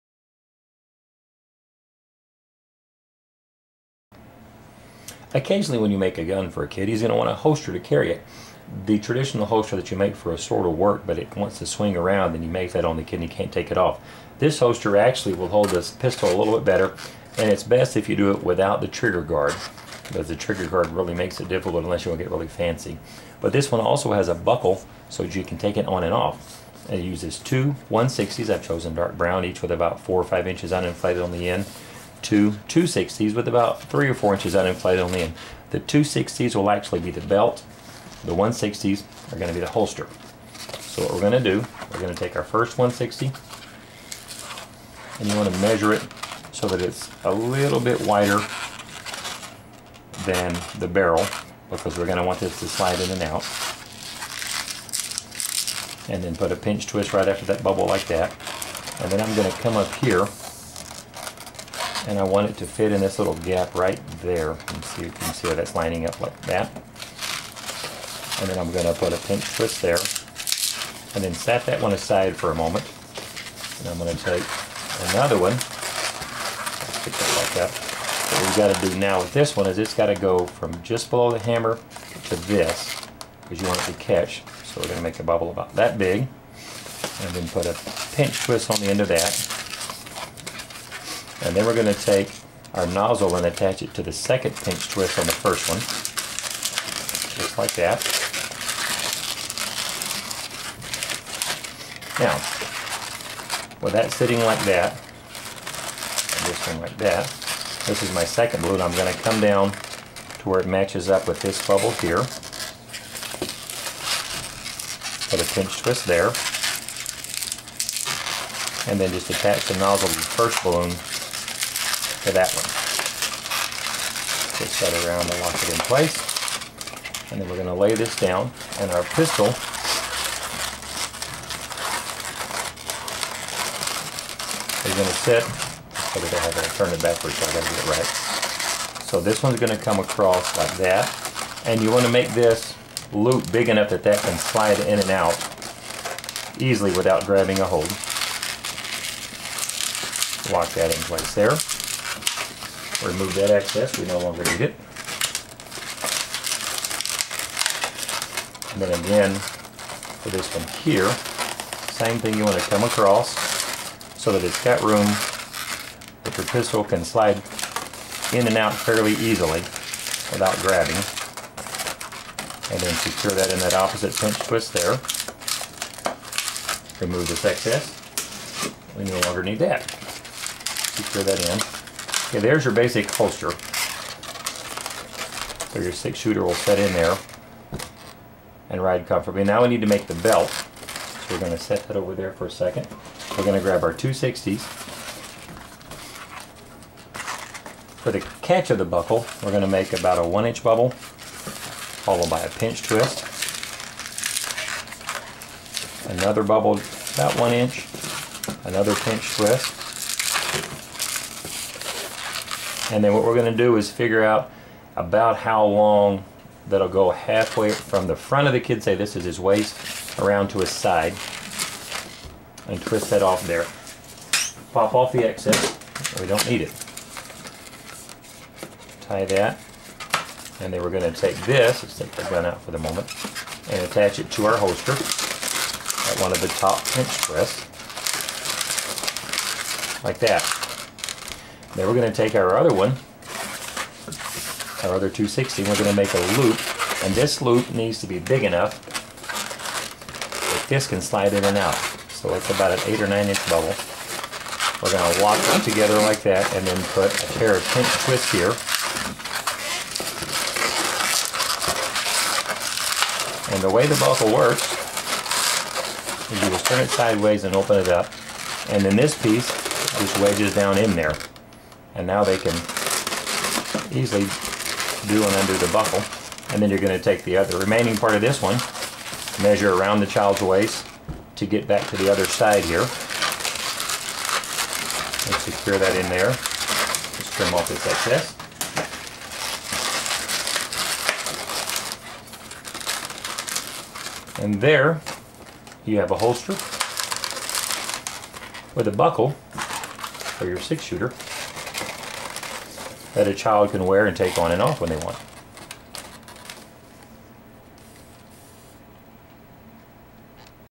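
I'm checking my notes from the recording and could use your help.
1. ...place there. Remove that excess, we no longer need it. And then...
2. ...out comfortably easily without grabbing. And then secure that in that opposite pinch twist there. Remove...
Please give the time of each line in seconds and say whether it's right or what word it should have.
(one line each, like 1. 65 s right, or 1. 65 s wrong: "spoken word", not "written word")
1. 151 s right
2. 168 s wrong: "fairly", not "comfortably".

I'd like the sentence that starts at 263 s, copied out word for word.
And the way the buckle works is you just turn it sideways and open it up.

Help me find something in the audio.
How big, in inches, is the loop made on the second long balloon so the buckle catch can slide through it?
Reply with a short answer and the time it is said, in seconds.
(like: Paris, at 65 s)
8 or 9 inches, at 252 s.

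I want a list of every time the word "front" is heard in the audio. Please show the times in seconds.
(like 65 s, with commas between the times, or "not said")
218 s.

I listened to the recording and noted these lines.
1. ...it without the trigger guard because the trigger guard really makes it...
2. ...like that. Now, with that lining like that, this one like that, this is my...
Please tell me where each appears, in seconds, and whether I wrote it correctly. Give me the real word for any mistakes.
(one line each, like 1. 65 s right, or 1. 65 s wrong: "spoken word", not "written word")
1. 18 s right
2. 97 s wrong: "sitting", not "lining".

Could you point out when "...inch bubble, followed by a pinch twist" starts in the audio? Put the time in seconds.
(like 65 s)
200 s.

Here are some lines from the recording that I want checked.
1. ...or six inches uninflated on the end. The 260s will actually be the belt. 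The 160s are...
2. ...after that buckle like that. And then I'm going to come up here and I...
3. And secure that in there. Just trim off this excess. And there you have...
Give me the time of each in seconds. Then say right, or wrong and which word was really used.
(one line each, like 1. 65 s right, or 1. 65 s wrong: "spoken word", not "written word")
1. 34 s wrong: "four", not "six"
2. 57 s wrong: "bubble", not "buckle"
3. 285 s right.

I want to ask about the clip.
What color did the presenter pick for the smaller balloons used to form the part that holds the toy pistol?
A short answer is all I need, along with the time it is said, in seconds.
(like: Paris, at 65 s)
Dark brown, at 28 s.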